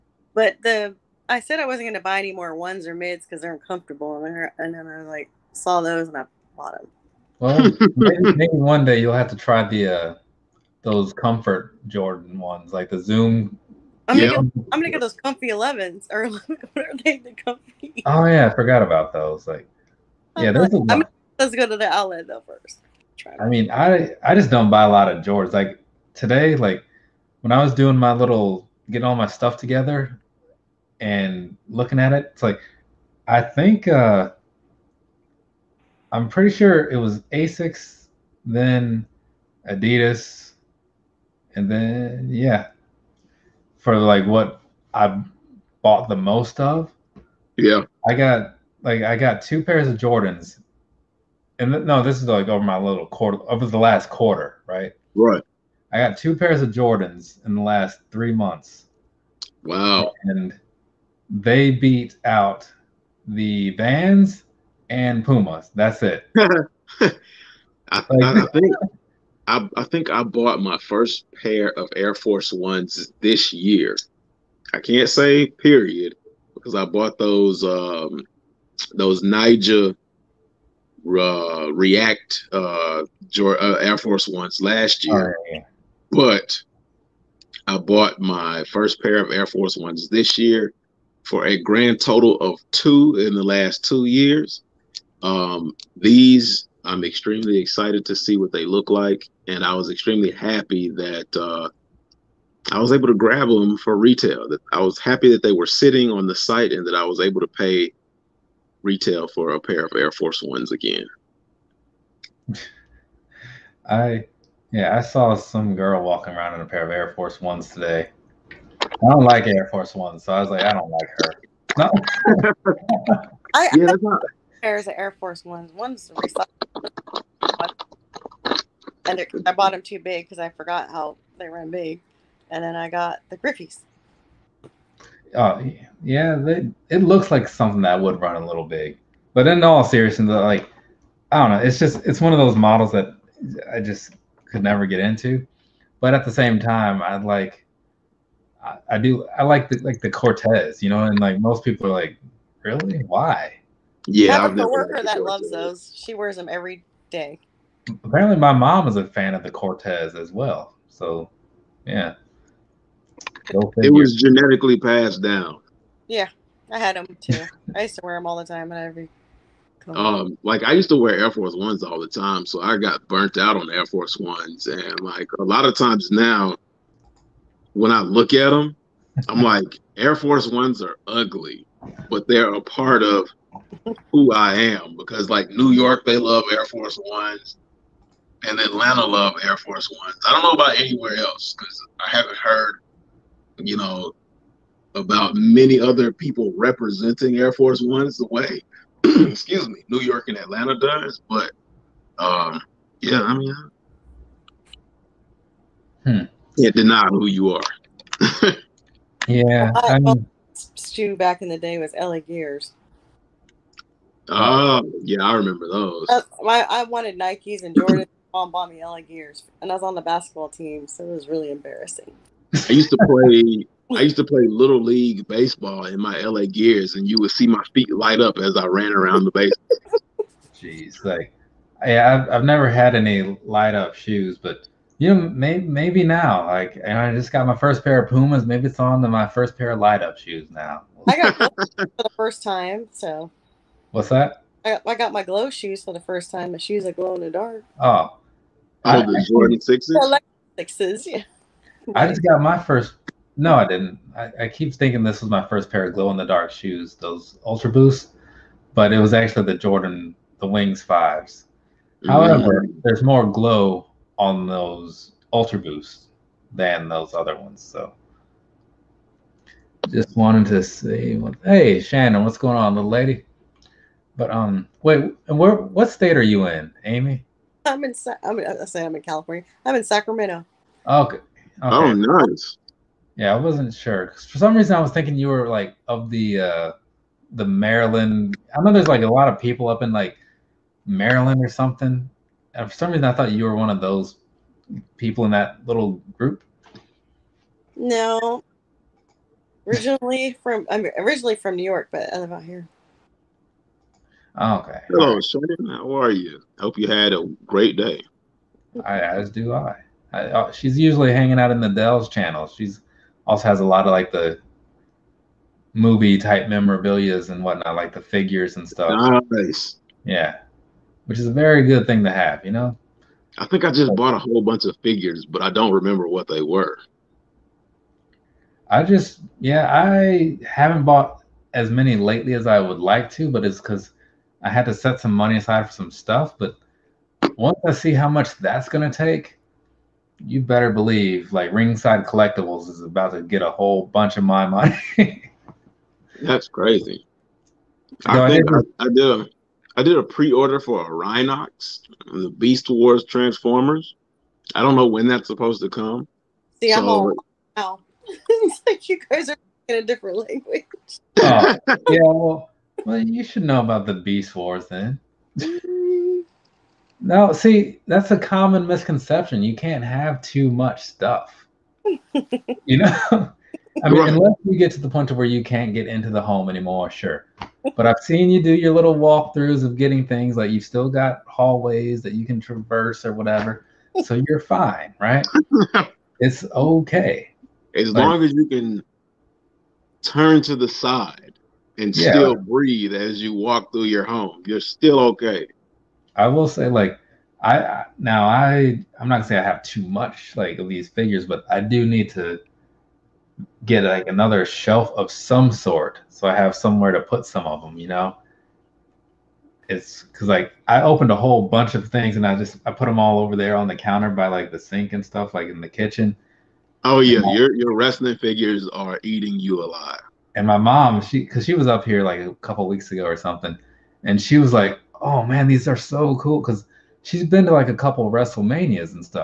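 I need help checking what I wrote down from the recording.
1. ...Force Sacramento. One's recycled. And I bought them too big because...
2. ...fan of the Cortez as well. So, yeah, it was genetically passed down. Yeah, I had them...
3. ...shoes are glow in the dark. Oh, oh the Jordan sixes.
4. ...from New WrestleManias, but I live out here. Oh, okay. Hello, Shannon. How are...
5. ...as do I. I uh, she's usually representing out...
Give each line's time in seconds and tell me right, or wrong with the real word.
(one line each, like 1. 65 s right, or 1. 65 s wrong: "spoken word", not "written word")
1. 125 s wrong: "Ones", not "Sacramento"
2. 159 s right
3. 246 s right
4. 301 s wrong: "York", not "WrestleManias"
5. 308 s wrong: "hanging", not "representing".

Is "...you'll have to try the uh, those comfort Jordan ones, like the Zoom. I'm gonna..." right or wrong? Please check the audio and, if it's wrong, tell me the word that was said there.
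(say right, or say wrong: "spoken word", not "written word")
right.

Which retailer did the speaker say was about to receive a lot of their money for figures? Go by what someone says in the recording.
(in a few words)
Ringside Collectibles.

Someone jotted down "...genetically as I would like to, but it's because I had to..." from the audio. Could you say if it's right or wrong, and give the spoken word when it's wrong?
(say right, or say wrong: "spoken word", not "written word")
wrong: "lately", not "genetically".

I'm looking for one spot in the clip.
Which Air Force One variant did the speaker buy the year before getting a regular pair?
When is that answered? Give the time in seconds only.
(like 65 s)
81 s.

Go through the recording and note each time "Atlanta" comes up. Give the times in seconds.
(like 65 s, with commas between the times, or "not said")
188 s, 200 s.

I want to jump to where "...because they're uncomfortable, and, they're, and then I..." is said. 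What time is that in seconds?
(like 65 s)
3 s.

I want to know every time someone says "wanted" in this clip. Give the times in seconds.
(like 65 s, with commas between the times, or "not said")
216 s, 270 s.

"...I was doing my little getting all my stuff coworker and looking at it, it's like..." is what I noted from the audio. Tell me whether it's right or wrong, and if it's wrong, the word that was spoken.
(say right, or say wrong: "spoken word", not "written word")
wrong: "together", not "coworker".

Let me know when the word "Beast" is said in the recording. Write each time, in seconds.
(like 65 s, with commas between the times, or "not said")
352 s, 363 s.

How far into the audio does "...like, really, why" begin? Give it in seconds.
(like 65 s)
151 s.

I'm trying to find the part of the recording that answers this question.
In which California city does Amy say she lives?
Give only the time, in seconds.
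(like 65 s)
279 s.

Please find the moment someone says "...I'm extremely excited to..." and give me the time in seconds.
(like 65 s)
96 s.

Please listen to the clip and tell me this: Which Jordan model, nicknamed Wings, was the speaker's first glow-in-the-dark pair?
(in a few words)
Jordan 5s.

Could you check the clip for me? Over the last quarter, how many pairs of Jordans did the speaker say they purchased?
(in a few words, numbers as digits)
2.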